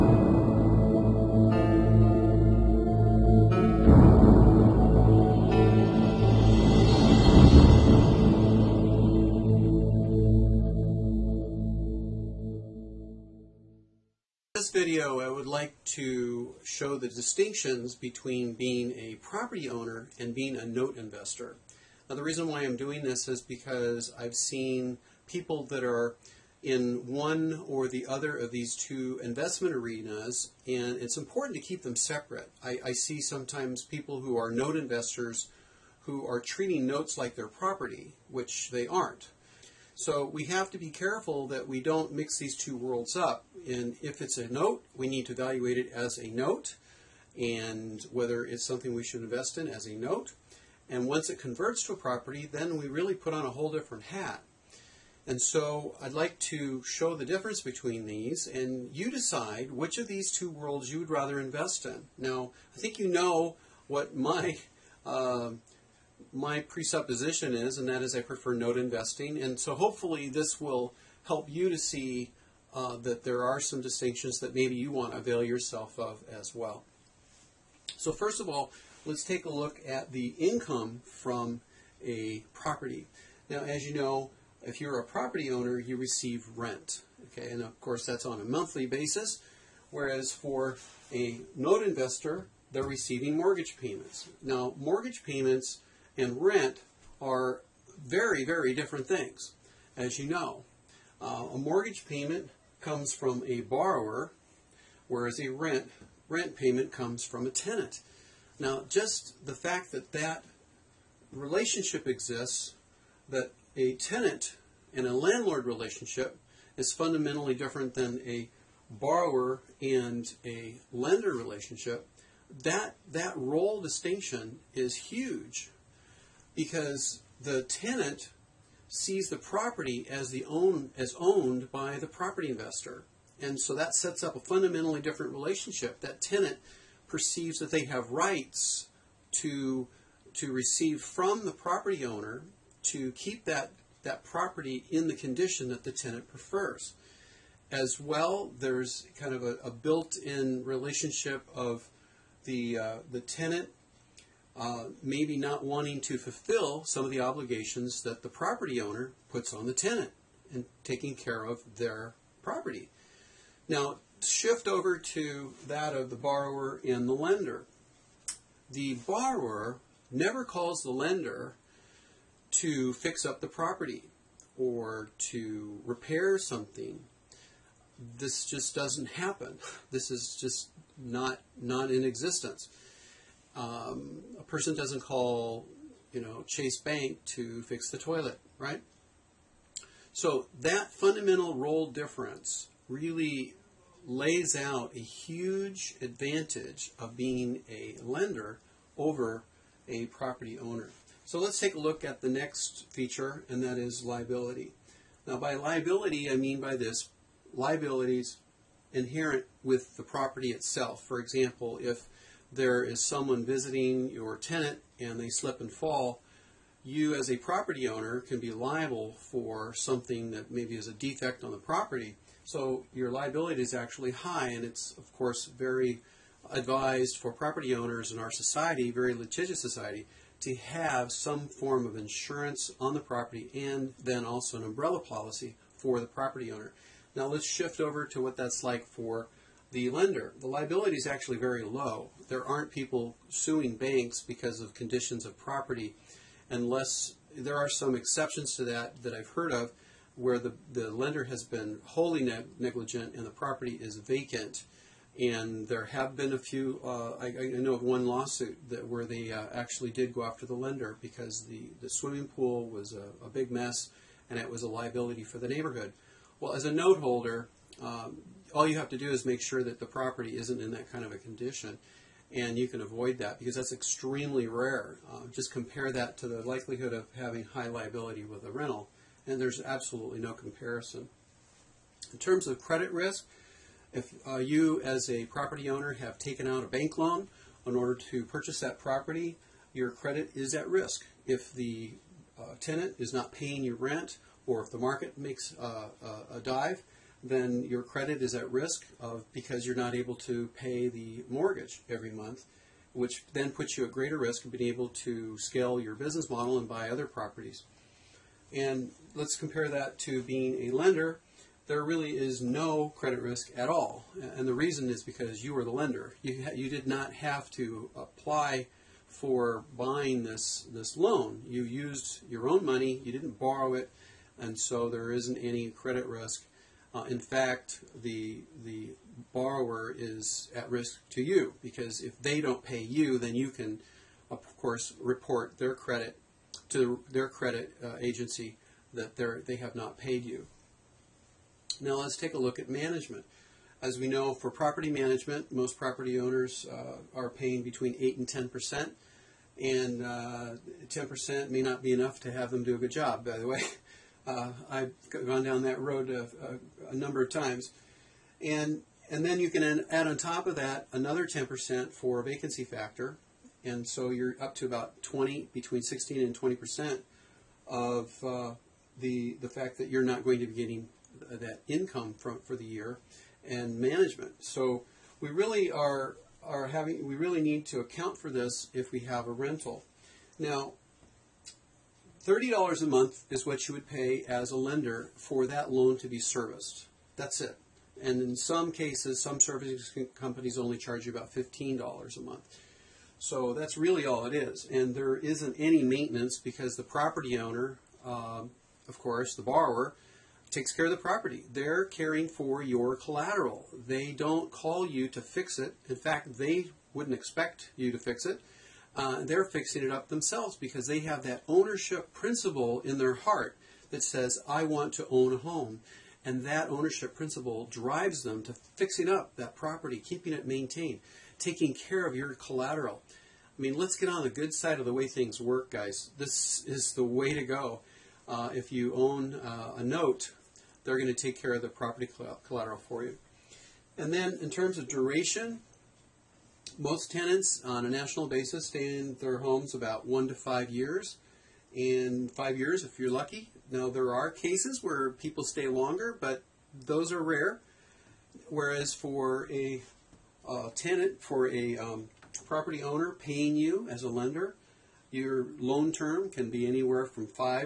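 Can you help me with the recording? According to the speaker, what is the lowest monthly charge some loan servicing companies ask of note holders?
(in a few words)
$15.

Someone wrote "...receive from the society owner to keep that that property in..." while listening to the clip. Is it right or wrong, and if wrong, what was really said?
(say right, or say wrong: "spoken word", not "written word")
wrong: "property", not "society".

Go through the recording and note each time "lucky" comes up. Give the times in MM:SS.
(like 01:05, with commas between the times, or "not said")
07:23.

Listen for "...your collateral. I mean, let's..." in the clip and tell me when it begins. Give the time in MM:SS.
07:02.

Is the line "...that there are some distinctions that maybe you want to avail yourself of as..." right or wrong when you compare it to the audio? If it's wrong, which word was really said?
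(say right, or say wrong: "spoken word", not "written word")
right.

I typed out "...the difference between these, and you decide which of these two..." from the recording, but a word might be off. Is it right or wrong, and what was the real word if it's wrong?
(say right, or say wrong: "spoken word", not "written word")
right.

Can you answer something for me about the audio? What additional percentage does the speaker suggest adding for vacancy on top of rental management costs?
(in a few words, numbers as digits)
10%.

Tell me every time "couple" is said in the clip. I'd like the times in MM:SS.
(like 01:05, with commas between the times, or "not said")
not said.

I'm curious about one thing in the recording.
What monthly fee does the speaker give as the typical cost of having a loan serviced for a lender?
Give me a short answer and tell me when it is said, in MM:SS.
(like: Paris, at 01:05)
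$30, at 06:22.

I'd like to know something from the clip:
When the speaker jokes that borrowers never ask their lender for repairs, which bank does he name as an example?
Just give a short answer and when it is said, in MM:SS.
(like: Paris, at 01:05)
Chase Bank, at 03:06.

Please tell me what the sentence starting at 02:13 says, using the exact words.
And so that sets up a fundamentally different relationship.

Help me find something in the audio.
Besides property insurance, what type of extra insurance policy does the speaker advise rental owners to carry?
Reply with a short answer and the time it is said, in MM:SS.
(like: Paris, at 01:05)
umbrella policy, at 03:54.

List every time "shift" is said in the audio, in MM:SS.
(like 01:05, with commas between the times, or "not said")
02:44, 03:57.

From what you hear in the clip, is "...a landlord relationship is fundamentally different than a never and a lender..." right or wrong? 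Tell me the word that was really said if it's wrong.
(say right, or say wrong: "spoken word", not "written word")
wrong: "borrower", not "never".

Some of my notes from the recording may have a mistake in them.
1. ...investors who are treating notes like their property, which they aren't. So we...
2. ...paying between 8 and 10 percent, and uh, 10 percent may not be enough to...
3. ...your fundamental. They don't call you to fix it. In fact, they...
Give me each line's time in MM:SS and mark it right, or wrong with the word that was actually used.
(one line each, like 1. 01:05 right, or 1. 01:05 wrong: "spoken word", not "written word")
1. 00:34 right
2. 05:47 right
3. 06:42 wrong: "collateral", not "fundamental".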